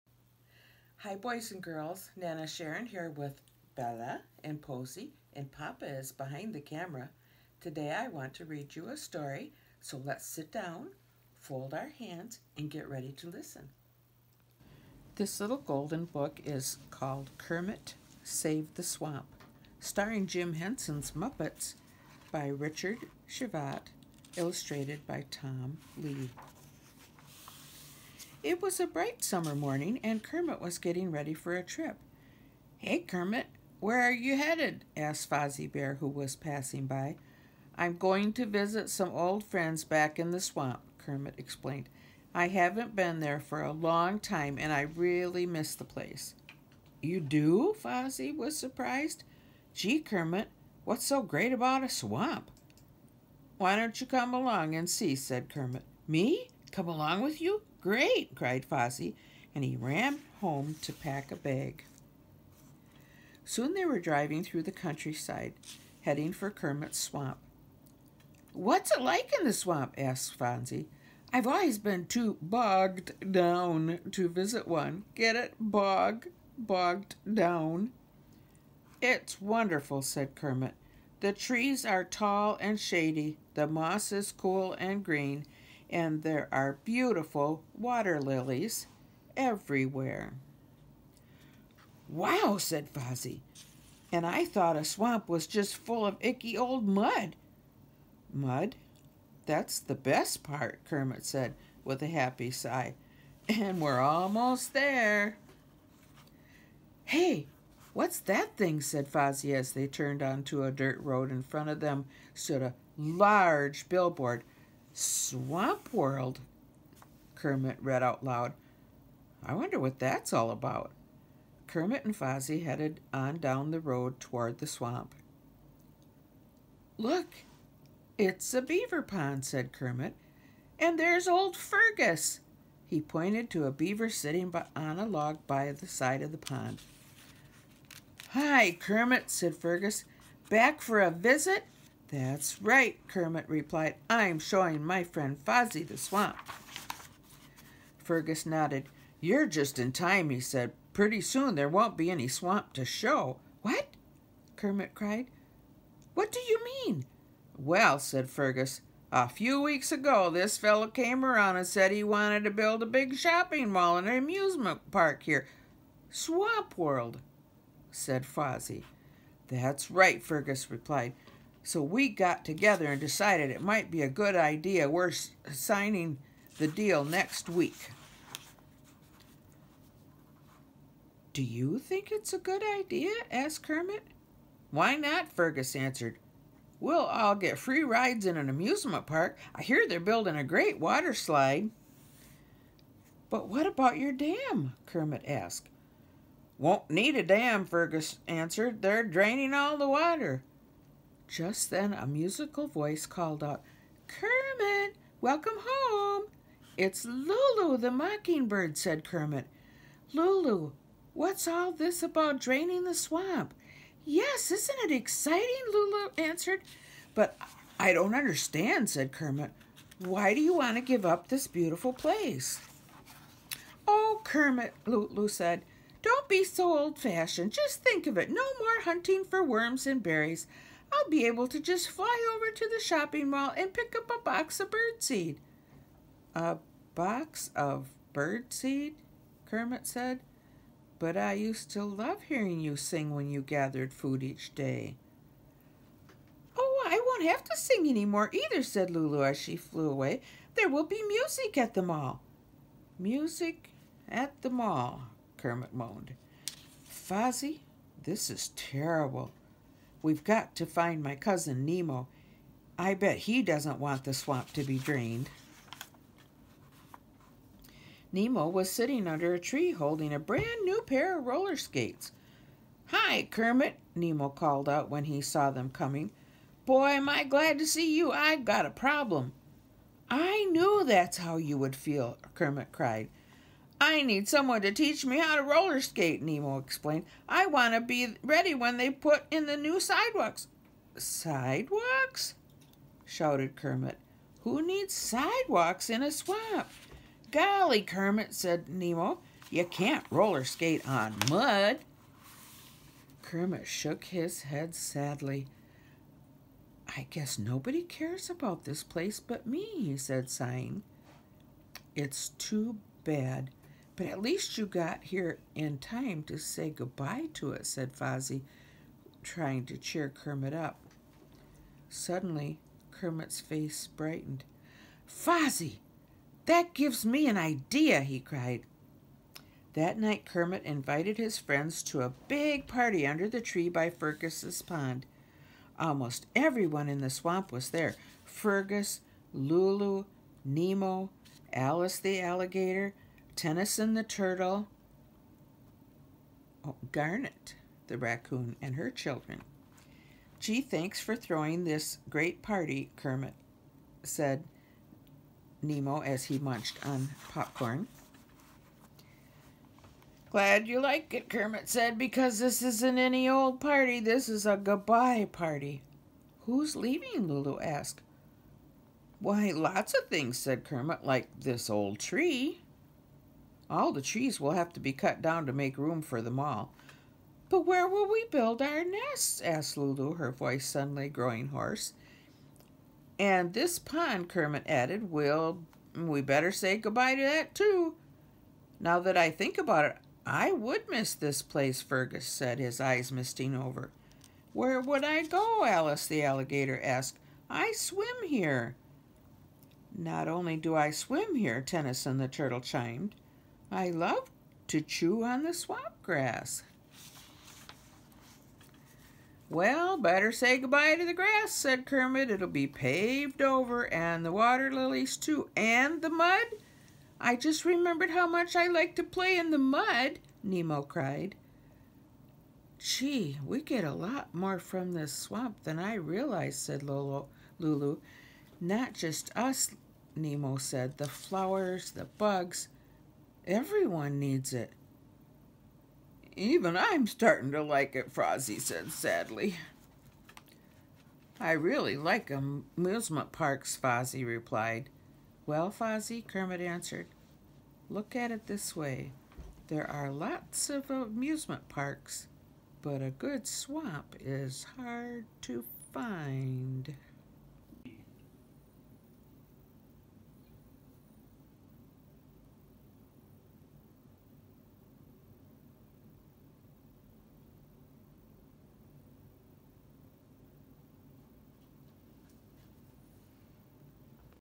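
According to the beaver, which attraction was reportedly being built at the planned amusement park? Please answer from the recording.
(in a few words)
water slide.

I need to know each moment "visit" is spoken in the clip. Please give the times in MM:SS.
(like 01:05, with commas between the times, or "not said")
00:38, 01:14, 02:21.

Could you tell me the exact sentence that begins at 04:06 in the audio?
Oh, I won't have to sing any more either, said Lulu as she flew away.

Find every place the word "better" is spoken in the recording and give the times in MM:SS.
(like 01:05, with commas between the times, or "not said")
06:26, 06:49.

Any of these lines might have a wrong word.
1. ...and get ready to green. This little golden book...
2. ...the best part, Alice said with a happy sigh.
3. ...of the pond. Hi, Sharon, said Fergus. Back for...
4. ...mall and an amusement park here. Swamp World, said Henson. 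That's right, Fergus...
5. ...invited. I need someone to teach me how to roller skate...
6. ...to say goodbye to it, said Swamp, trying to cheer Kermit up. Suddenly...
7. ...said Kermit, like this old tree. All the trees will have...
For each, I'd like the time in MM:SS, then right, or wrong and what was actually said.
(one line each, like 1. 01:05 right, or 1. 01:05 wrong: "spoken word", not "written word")
1. 00:12 wrong: "listen", not "green"
2. 01:39 wrong: "Kermit", not "Alice"
3. 02:16 wrong: "Kermit", not "Sharon"
4. 02:43 wrong: "Fozzie", not "Henson"
5. 04:42 wrong: "cried", not "invited"
6. 05:16 wrong: "Fozzie", not "Swamp"
7. 06:10 right.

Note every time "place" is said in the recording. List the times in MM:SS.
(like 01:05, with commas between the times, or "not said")
00:45, 03:41, 05:08, 06:31.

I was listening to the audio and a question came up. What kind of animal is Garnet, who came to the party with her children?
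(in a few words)
raccoon.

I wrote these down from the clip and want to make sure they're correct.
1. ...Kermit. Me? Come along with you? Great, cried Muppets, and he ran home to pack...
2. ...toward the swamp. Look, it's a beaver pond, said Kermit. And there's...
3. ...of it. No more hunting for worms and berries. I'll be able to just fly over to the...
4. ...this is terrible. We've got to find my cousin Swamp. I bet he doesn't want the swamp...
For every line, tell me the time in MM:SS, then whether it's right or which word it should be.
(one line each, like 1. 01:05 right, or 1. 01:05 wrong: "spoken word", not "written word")
1. 00:55 wrong: "Fozzie", not "Muppets"
2. 02:04 right
3. 03:48 right
4. 04:18 wrong: "Nemo", not "Swamp".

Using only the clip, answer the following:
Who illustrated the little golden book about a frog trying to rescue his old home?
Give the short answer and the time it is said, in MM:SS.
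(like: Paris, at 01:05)
Tom Leigh, at 00:25.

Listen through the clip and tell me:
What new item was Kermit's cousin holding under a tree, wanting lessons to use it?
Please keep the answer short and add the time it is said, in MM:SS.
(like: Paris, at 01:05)
roller skates, at 04:31.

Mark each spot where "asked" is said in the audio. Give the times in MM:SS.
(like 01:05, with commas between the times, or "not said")
00:34, 01:09, 03:03, 03:15, 06:07, 06:19, 06:36.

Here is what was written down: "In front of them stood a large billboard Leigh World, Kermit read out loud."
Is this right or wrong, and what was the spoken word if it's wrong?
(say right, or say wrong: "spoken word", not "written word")
wrong: "Swamp", not "Leigh".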